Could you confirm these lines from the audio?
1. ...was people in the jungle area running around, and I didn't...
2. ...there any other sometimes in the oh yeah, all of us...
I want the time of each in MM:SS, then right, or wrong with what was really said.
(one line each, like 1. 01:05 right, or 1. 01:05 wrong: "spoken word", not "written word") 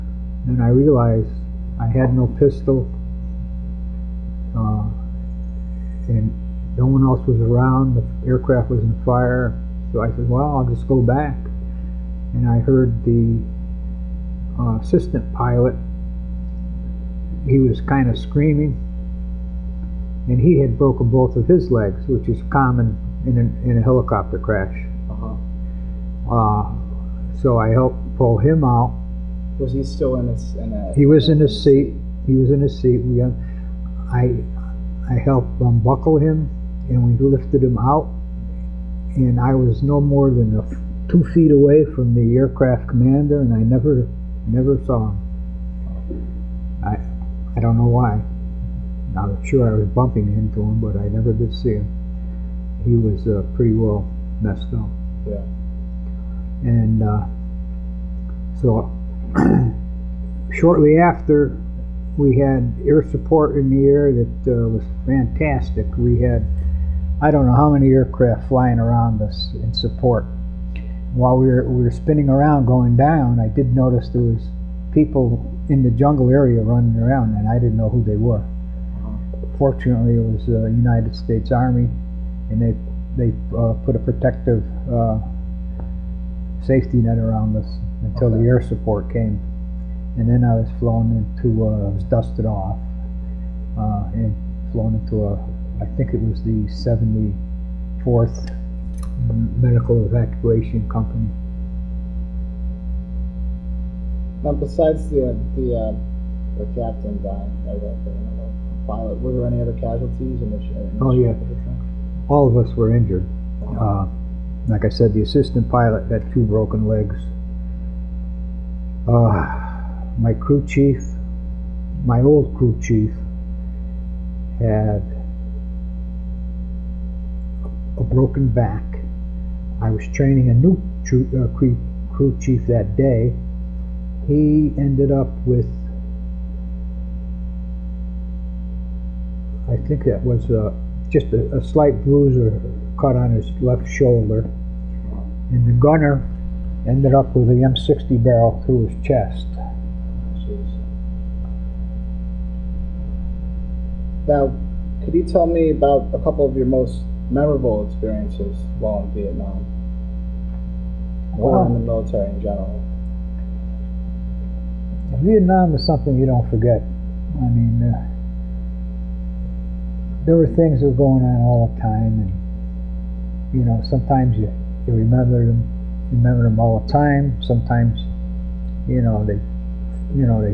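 1. 01:14 right
2. 01:49 wrong: "casualties", not "sometimes".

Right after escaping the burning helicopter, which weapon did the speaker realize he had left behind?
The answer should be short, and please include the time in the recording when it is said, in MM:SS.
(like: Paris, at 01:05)
pistol, at 00:02.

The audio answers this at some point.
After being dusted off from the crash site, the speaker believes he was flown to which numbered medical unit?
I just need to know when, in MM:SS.
01:36.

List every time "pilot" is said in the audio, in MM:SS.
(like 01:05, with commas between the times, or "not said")
00:15, 01:48, 01:55.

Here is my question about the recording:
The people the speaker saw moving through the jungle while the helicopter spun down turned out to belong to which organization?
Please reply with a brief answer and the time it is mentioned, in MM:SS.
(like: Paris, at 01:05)
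United States Army, at 01:20.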